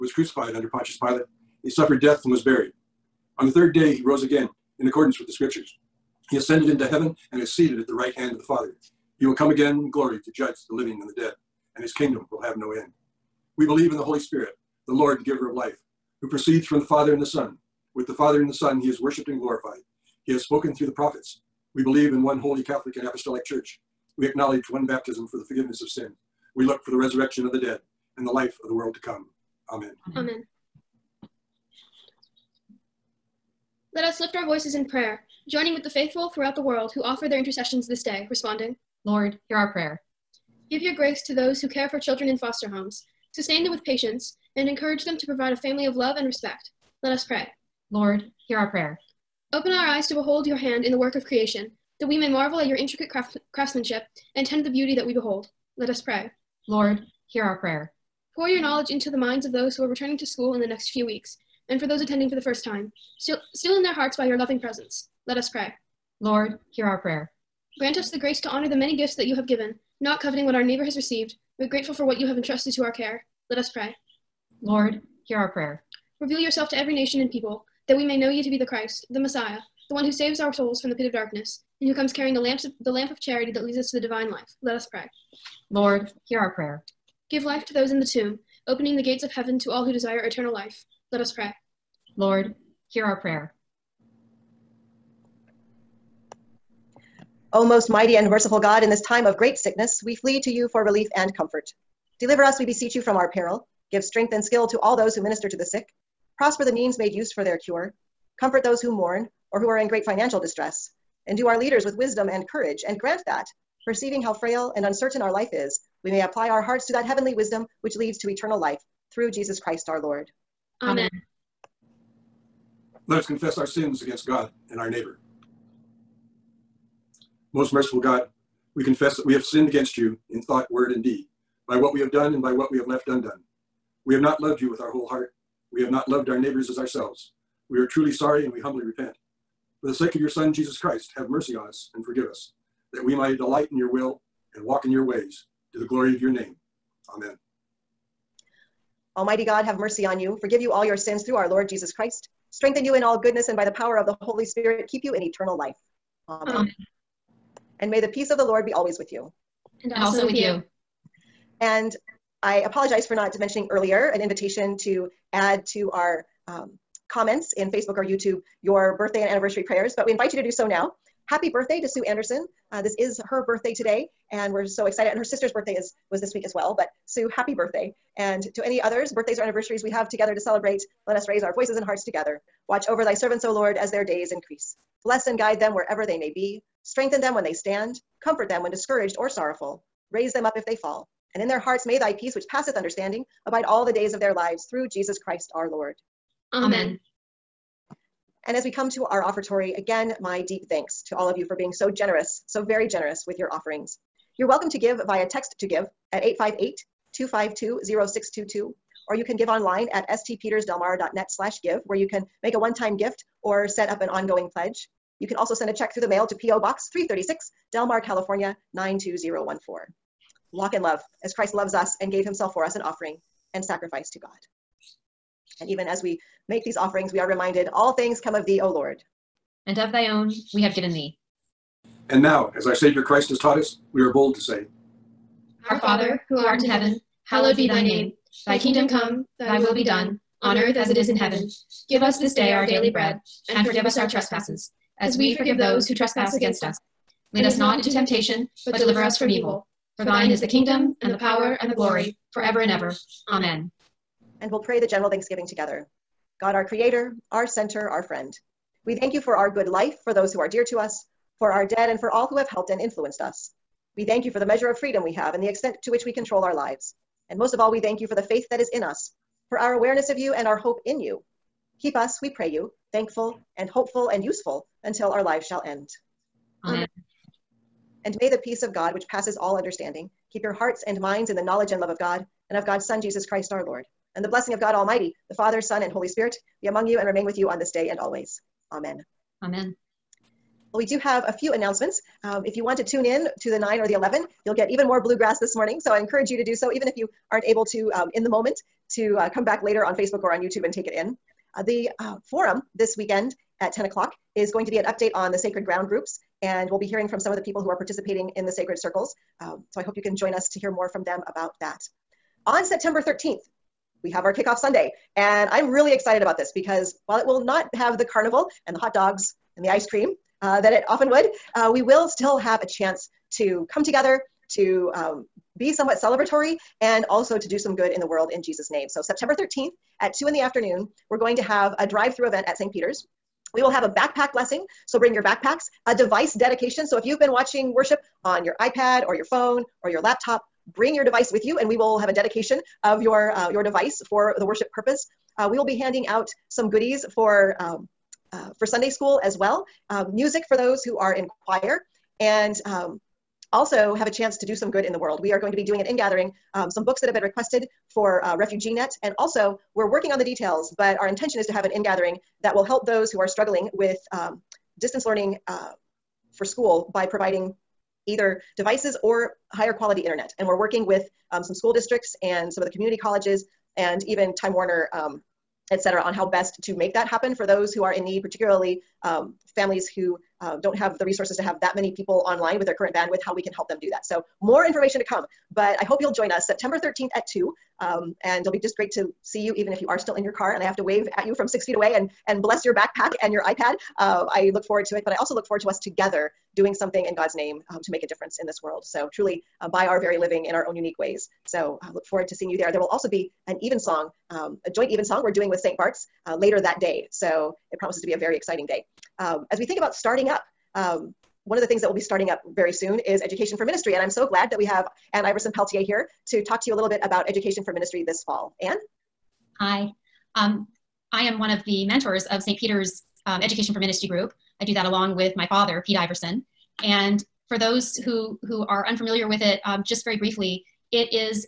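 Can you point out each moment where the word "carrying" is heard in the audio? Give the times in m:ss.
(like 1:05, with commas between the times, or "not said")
1:22.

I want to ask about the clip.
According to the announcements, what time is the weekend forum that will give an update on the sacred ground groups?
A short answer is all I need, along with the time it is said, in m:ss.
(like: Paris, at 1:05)
10 o'clock, at 5:03.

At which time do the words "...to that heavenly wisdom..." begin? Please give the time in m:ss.
1:56.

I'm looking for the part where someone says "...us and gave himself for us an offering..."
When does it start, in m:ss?
3:41.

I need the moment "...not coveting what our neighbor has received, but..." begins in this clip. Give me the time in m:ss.
1:10.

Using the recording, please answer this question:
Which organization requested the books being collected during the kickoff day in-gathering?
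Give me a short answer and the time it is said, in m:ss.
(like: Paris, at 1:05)
Refugee Net, at 5:58.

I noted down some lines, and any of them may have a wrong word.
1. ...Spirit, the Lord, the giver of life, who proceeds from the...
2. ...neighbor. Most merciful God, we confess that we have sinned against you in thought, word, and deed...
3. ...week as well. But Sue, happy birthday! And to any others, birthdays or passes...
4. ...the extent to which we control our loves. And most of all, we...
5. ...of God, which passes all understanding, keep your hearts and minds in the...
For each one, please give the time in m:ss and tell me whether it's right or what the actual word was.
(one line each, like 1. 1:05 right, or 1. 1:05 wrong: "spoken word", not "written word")
1. 0:14 right
2. 2:04 right
3. 2:56 wrong: "anniversaries", not "passes"
4. 4:25 wrong: "lives", not "loves"
5. 4:38 right.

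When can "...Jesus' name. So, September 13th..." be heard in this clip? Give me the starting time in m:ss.
5:28.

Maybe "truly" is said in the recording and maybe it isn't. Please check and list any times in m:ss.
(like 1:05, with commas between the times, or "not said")
2:17, 6:39.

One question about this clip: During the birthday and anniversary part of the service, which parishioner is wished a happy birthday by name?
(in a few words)
Sue Anderson.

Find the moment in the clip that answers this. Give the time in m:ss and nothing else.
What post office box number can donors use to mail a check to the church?
3:36.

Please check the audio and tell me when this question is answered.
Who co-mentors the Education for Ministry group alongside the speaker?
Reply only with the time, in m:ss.
7:05.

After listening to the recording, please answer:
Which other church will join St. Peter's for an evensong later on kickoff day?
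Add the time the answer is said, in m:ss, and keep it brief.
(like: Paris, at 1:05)
St. Bart's, at 6:45.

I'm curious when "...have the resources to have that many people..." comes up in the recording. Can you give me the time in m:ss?
6:20.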